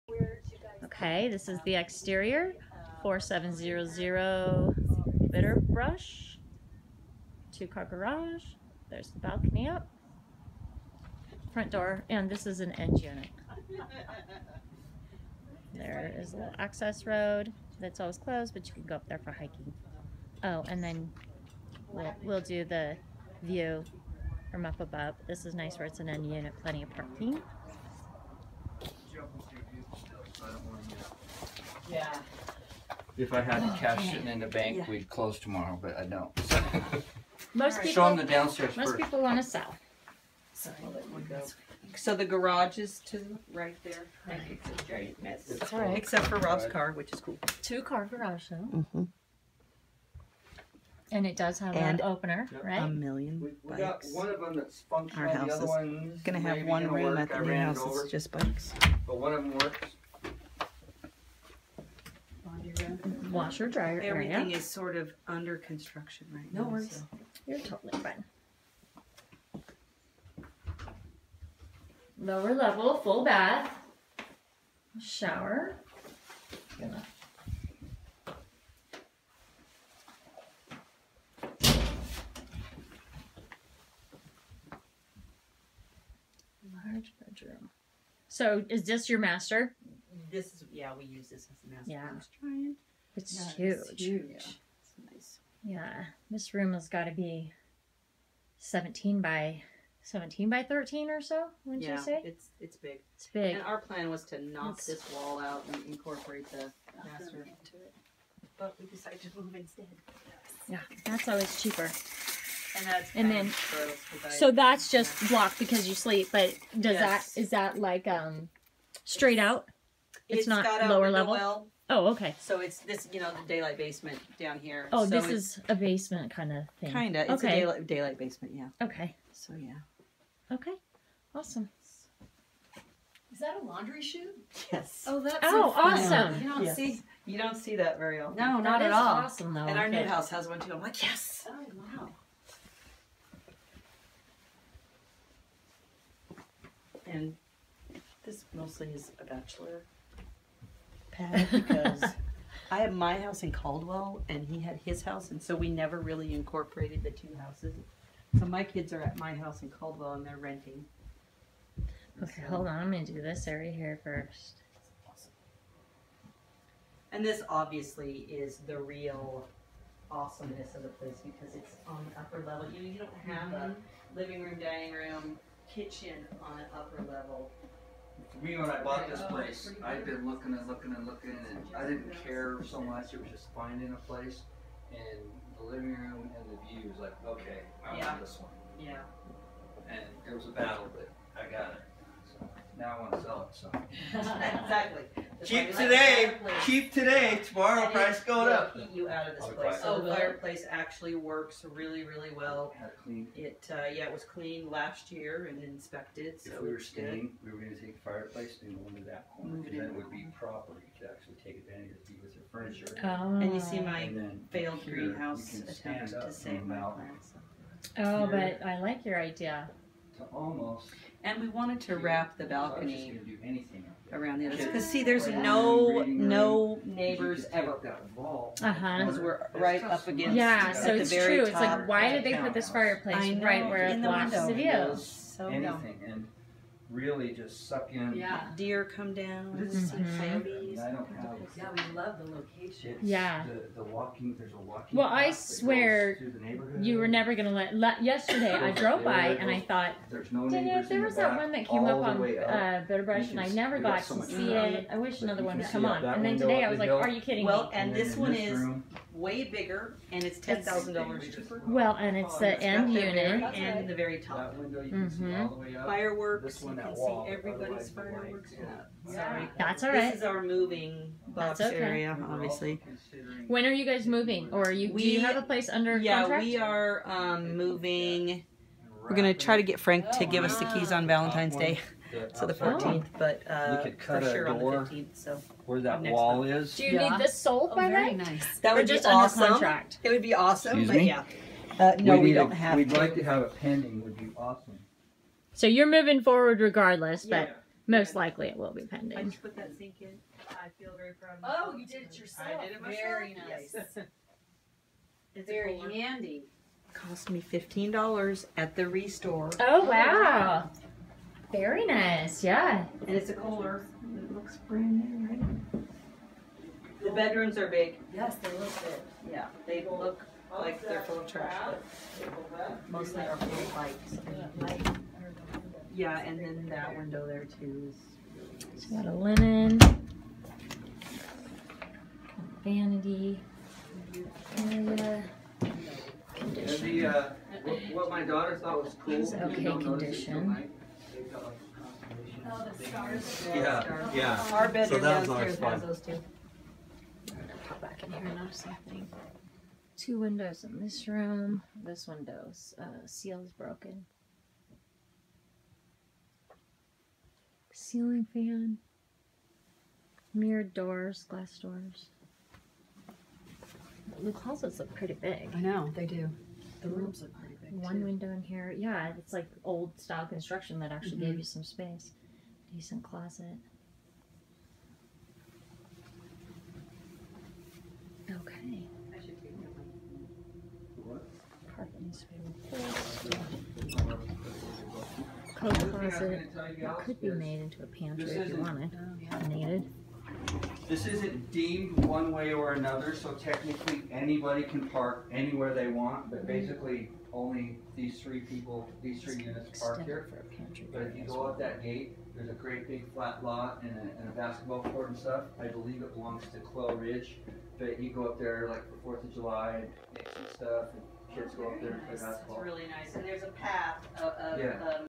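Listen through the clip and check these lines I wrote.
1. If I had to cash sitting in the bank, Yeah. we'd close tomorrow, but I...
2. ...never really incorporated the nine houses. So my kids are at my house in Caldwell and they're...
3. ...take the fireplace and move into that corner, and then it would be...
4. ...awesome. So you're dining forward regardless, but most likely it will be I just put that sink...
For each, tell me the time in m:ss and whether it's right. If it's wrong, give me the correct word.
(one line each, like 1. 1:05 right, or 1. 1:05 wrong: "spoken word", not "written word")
1. 0:33 right
2. 2:35 wrong: "two", not "nine"
3. 3:27 right
4. 4:54 wrong: "moving", not "dining".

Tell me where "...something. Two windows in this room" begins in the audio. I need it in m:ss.
5:48.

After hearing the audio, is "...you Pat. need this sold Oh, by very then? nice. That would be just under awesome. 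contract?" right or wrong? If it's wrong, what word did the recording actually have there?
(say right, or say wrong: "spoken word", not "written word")
wrong: "Yeah", not "Pat".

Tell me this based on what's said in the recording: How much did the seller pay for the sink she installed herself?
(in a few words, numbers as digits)
$15.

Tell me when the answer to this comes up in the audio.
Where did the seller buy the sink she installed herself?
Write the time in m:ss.
5:08.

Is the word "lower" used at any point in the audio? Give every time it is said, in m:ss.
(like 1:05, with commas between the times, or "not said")
1:12, 2:00.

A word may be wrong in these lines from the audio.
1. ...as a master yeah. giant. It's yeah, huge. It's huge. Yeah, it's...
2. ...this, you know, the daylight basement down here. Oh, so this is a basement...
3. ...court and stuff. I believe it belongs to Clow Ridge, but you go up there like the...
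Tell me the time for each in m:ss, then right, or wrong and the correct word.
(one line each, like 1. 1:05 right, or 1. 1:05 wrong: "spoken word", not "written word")
1. 1:31 right
2. 2:02 right
3. 6:44 right.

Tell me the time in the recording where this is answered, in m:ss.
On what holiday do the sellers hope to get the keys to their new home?
4:41.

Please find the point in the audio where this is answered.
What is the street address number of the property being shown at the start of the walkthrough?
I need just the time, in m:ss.
0:03.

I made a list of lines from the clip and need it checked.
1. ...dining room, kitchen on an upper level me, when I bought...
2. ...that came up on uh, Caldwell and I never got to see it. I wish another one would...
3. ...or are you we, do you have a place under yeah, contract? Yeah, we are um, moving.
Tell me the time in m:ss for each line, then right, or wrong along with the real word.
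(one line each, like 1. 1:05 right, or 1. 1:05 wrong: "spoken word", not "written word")
1. 2:54 right
2. 4:11 wrong: "Bitterbrush", not "Caldwell"
3. 4:34 right.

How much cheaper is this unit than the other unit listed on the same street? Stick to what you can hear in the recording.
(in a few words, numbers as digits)
$10,000.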